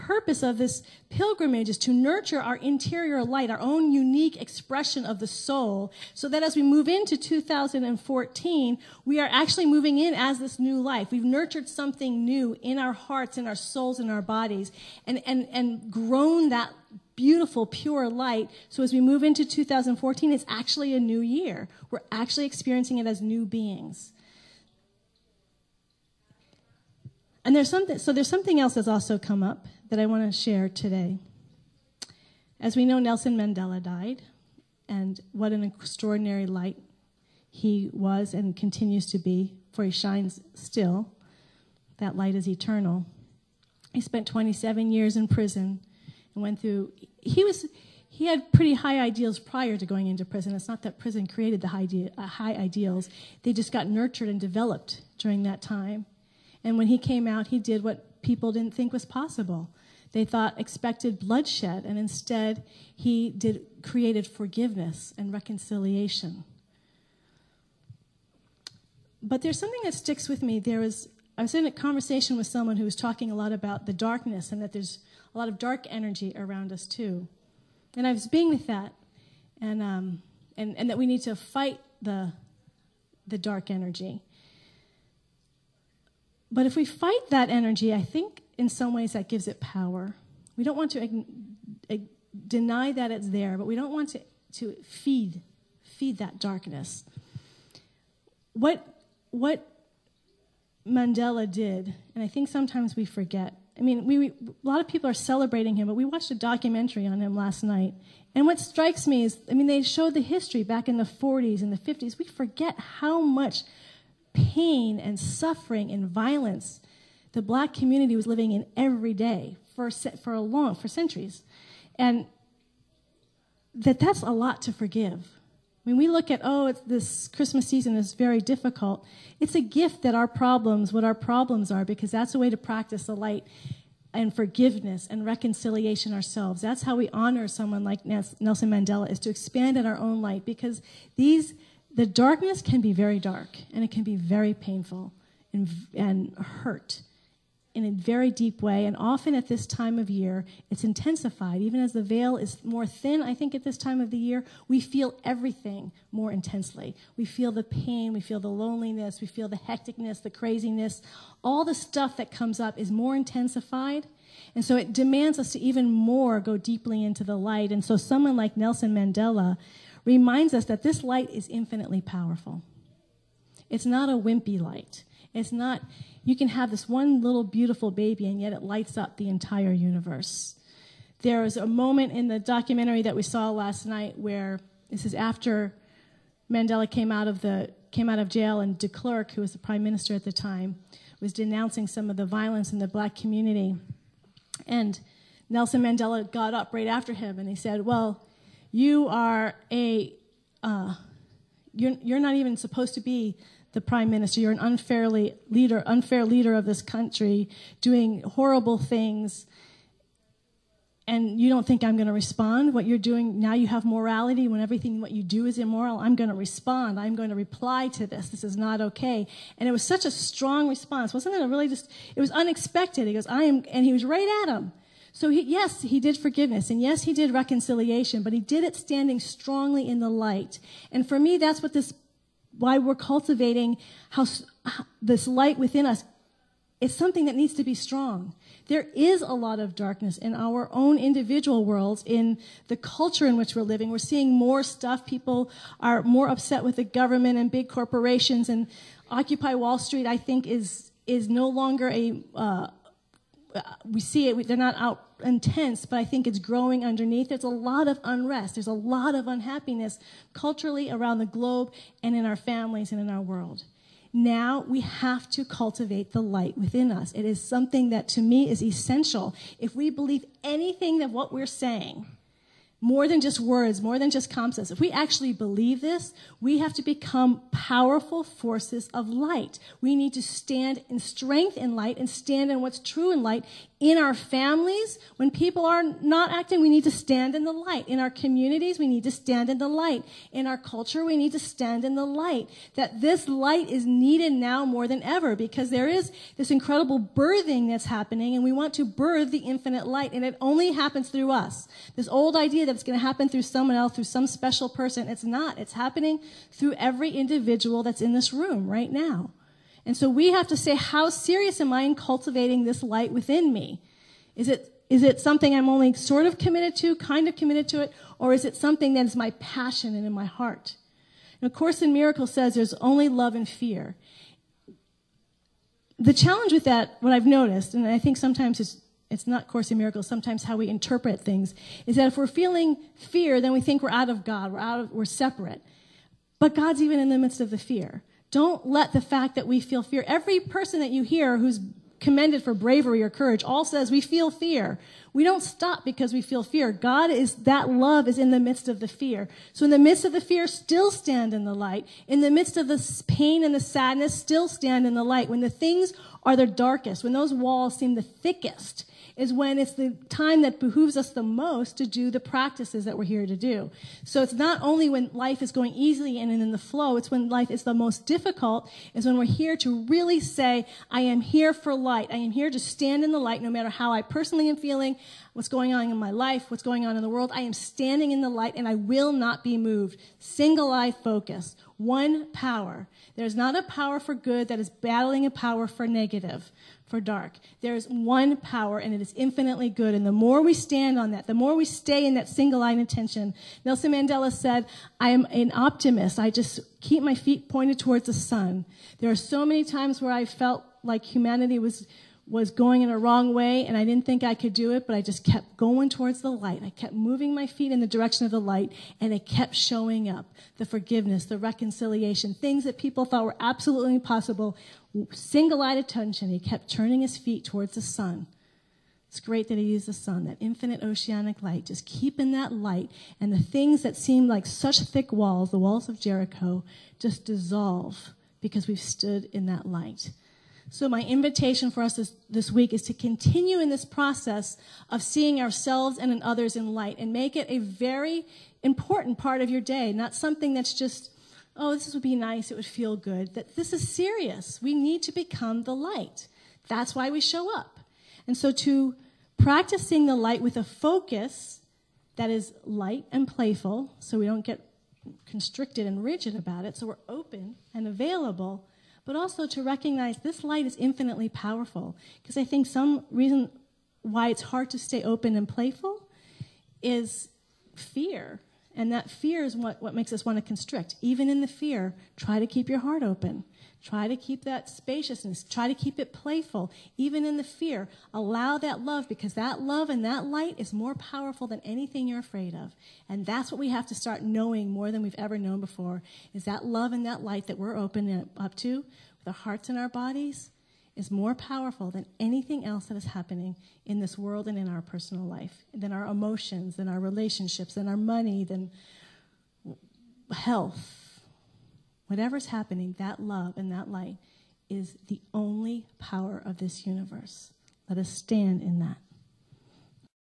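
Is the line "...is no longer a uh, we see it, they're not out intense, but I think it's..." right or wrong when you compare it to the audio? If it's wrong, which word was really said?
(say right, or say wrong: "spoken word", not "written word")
right.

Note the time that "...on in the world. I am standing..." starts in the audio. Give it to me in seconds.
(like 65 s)
376 s.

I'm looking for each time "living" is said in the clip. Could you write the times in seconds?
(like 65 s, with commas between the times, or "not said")
118 s, 243 s.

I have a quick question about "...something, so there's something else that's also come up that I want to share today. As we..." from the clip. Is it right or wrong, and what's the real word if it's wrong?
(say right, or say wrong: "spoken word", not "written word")
right.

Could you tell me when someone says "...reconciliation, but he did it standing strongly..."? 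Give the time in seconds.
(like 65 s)
227 s.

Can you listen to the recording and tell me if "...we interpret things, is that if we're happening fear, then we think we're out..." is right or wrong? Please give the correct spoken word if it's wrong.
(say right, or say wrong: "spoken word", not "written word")
wrong: "feeling", not "happening".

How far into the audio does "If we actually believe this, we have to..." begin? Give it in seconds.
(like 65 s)
274 s.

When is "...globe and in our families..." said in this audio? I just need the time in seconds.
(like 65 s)
261 s.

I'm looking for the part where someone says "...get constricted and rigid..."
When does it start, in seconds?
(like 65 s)
454 s.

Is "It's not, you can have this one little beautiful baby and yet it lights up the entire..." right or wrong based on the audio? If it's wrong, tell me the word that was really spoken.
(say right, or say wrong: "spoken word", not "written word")
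right.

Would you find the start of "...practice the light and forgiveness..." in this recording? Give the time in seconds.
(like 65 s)
132 s.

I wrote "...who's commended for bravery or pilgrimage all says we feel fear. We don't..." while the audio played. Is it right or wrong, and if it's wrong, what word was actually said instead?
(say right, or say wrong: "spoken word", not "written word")
wrong: "courage", not "pilgrimage".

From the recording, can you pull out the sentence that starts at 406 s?
I kept moving my feet in the direction of the light and it kept showing up.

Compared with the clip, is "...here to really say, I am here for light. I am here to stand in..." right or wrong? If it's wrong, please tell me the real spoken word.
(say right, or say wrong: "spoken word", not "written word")
right.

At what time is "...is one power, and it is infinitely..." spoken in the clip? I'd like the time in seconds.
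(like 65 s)
387 s.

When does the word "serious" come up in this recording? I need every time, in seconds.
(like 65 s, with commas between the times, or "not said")
311 s, 443 s.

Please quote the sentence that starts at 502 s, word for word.
Whatever's happening, that love and that light is the only power of this universe.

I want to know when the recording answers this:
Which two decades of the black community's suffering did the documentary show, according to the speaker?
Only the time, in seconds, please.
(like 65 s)
110 s.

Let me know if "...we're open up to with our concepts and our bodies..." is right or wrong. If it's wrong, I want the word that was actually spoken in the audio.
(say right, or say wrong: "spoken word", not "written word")
wrong: "hearts", not "concepts".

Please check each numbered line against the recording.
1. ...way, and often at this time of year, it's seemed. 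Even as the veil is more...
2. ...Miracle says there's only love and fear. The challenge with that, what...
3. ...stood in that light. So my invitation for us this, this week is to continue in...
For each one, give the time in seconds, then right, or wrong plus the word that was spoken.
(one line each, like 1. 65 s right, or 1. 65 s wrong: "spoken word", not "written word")
1. 148 s wrong: "intensified", not "seemed"
2. 321 s right
3. 428 s right.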